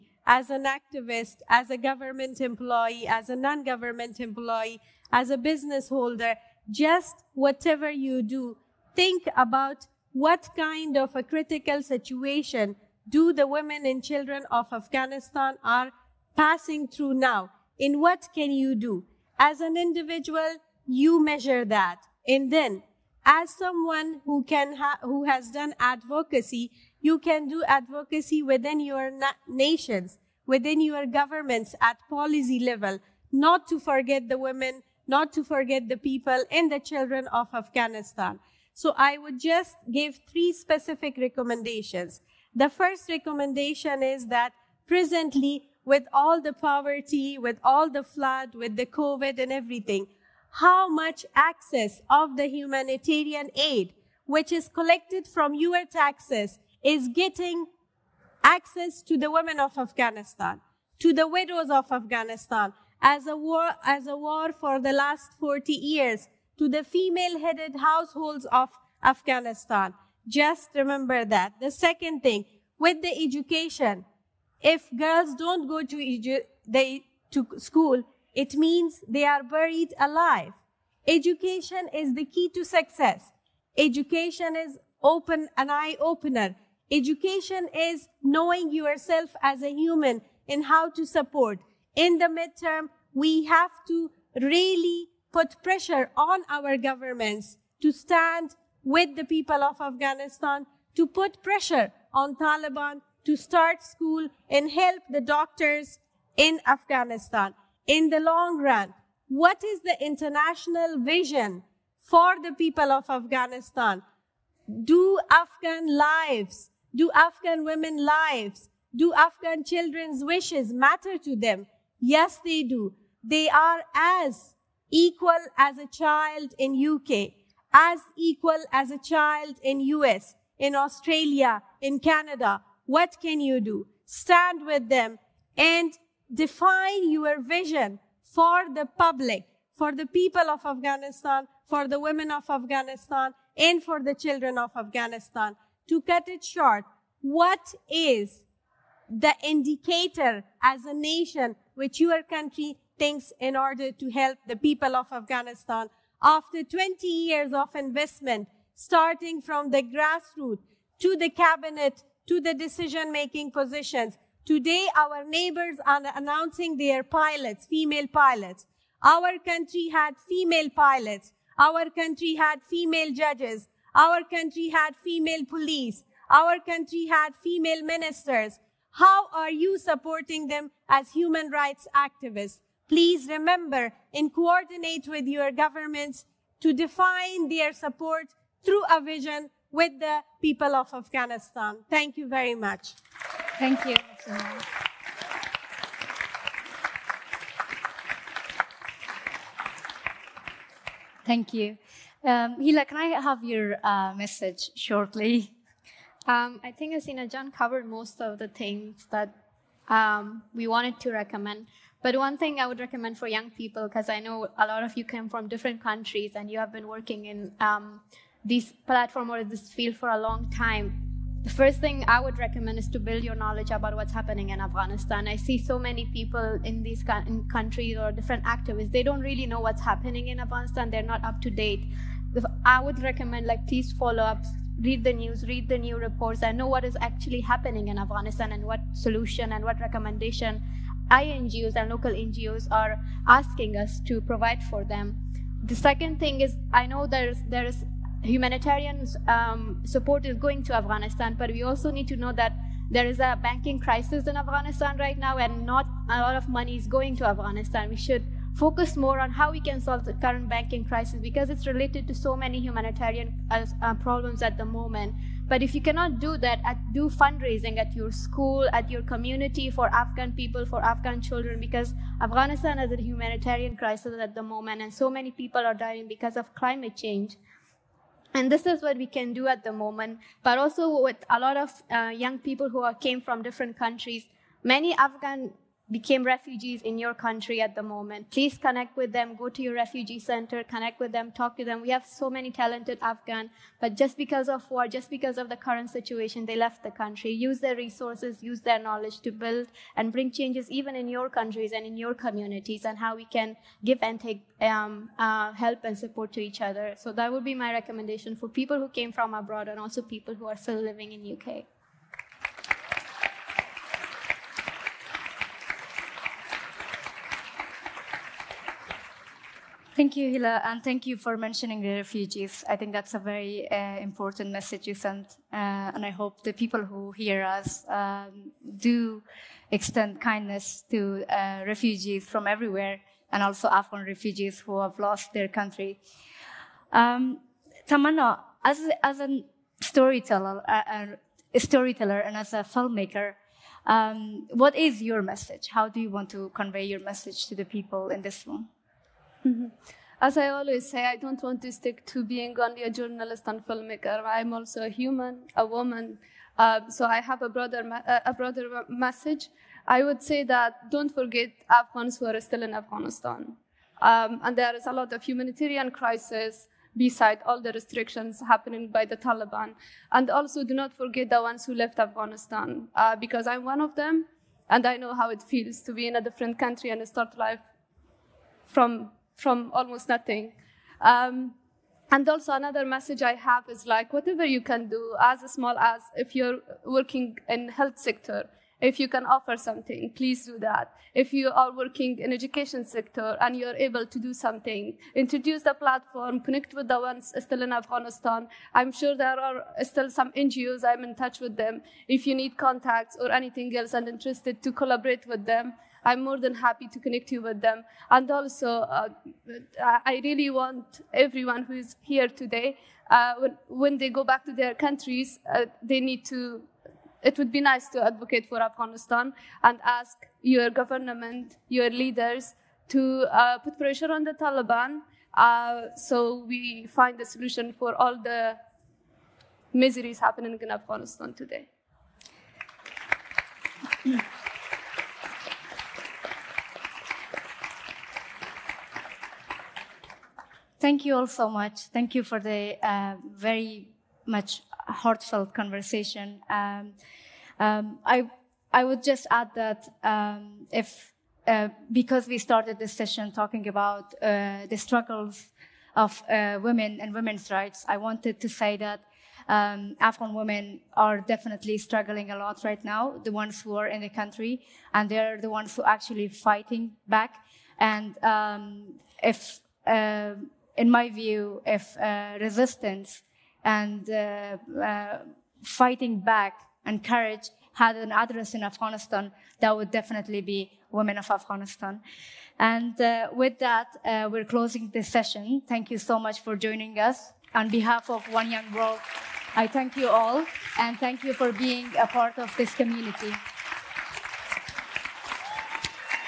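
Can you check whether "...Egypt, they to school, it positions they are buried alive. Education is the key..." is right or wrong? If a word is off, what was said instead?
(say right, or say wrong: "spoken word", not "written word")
wrong: "means", not "positions".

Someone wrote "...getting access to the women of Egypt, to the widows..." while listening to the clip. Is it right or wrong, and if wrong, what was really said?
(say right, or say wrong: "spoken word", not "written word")
wrong: "Afghanistan", not "Egypt".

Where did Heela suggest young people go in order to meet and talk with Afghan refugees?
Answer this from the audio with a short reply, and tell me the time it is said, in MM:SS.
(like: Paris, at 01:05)
refugee center, at 04:49.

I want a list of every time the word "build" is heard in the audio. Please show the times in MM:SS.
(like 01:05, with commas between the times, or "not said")
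03:42, 04:59.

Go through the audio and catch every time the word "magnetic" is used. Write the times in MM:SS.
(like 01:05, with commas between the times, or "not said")
not said.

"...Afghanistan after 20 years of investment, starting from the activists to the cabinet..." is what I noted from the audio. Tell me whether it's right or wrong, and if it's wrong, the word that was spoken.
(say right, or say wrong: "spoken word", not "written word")
wrong: "grassroots", not "activists".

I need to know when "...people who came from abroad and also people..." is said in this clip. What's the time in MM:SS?
05:08.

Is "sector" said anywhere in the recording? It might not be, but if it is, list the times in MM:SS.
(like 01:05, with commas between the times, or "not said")
06:27, 06:32.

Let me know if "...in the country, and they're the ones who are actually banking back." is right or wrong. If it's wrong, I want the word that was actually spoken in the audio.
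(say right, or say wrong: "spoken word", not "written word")
wrong: "fighting", not "banking".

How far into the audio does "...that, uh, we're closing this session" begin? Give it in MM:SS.
08:03.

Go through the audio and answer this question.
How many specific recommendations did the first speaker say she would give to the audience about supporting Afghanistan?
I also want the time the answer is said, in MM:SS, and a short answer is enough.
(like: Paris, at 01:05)
3, at 00:40.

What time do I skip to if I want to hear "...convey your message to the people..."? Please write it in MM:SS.
05:46.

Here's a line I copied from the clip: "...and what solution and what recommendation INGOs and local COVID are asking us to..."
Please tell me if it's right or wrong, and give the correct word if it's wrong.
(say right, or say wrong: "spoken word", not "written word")
wrong: "NGOs", not "COVID".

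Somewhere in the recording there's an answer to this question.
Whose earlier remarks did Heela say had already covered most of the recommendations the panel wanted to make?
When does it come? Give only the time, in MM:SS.
03:26.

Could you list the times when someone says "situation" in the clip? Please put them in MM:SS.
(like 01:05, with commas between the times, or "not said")
00:11, 04:55.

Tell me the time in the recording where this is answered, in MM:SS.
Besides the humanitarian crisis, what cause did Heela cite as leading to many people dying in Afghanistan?
04:36.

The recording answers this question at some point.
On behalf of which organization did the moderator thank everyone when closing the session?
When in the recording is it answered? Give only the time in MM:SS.
08:08.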